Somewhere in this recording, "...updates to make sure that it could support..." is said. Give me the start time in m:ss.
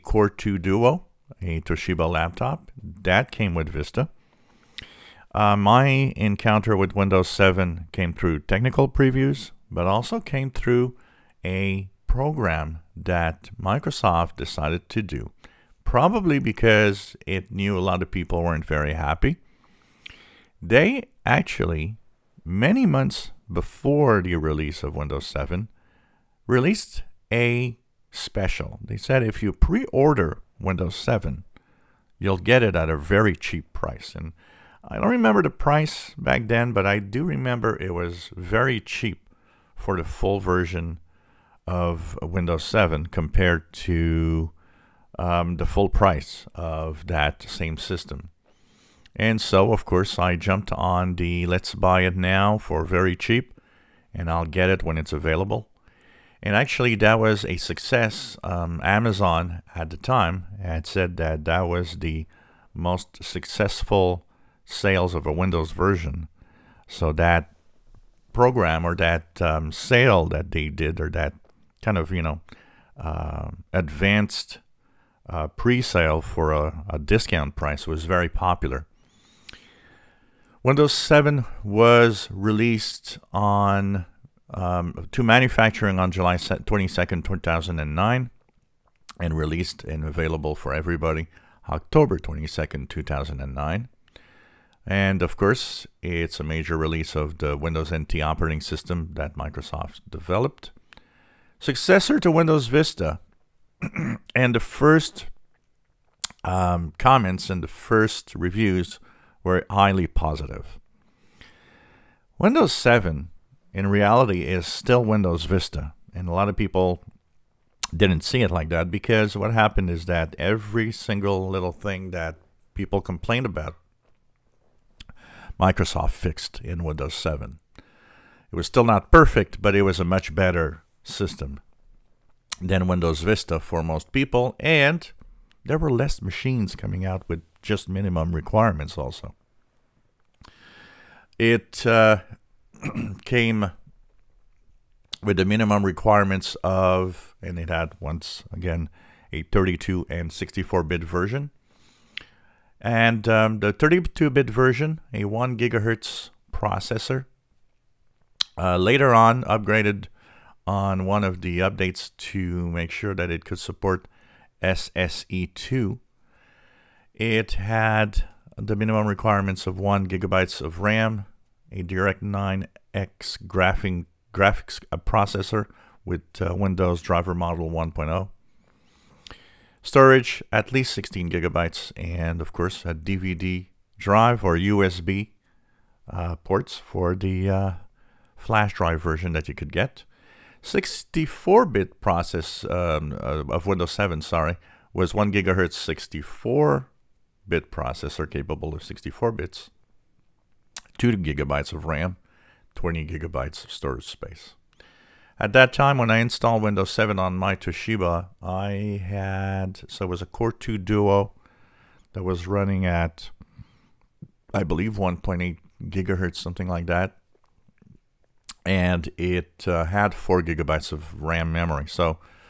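2:41.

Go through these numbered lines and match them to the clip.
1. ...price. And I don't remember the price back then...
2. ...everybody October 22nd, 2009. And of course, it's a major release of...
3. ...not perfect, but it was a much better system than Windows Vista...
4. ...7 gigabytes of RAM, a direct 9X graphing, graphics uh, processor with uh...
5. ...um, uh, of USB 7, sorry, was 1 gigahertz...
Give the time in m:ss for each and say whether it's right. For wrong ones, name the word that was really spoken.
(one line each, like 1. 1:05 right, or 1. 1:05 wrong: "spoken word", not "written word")
1. 0:33 right
2. 1:30 right
3. 2:08 right
4. 2:49 wrong: "1", not "7"
5. 3:12 wrong: "Windows", not "USB".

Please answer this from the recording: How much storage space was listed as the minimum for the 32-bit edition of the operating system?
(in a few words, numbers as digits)
16 gigabytes.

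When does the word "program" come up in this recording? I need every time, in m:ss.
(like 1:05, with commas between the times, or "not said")
0:12, 1:08.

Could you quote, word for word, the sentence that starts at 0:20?
They actually, many months before the release of Windows 7, released a special.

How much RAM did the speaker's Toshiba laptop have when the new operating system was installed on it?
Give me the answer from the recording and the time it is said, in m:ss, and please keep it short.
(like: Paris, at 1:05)
4 gigabytes, at 3:40.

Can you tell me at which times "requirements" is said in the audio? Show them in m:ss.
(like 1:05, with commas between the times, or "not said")
2:18, 2:25, 2:49.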